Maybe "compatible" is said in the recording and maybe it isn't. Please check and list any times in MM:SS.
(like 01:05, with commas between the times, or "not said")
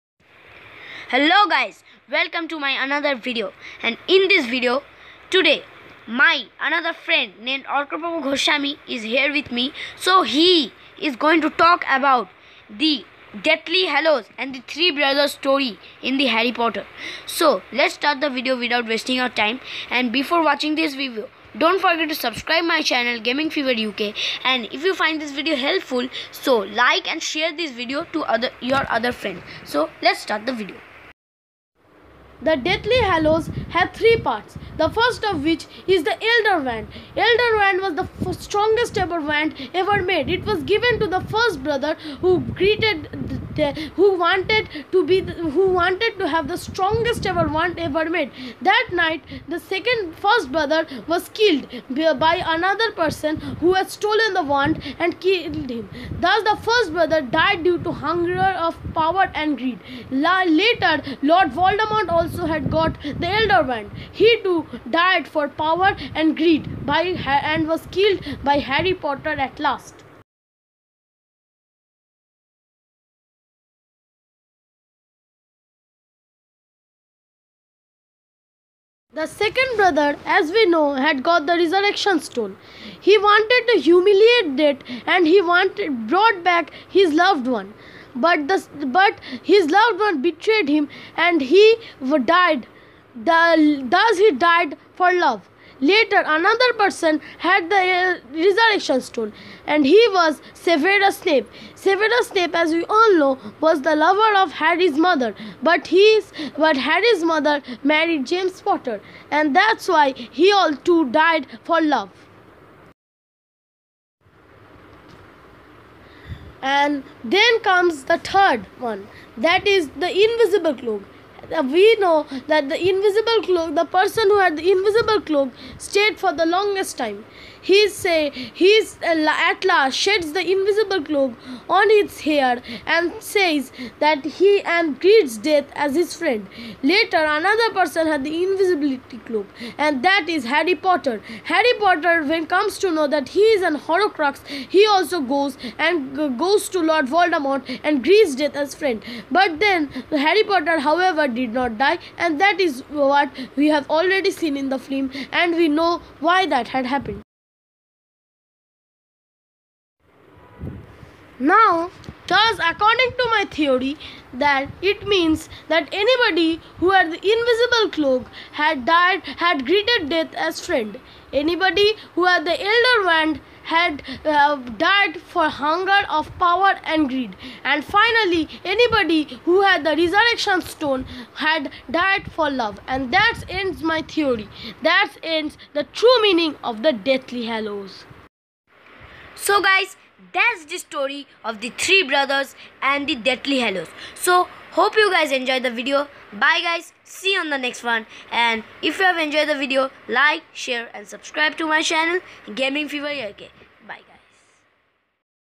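not said.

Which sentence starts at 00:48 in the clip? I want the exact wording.
That night, the second first brother was killed by another person who had stolen the wand and killed him.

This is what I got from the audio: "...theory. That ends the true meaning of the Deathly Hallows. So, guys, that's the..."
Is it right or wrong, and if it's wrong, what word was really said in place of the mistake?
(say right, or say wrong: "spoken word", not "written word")
right.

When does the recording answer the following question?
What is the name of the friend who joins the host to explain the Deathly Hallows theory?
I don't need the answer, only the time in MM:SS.
00:07.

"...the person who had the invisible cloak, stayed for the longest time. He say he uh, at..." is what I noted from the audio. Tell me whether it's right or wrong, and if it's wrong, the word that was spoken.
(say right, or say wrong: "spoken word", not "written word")
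right.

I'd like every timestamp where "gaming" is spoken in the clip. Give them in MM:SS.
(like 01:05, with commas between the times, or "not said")
00:23, 03:22.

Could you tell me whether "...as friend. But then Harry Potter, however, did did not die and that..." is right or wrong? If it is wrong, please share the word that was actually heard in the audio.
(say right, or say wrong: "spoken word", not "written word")
right.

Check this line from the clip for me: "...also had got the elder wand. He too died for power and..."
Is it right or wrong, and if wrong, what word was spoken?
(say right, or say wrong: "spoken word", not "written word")
right.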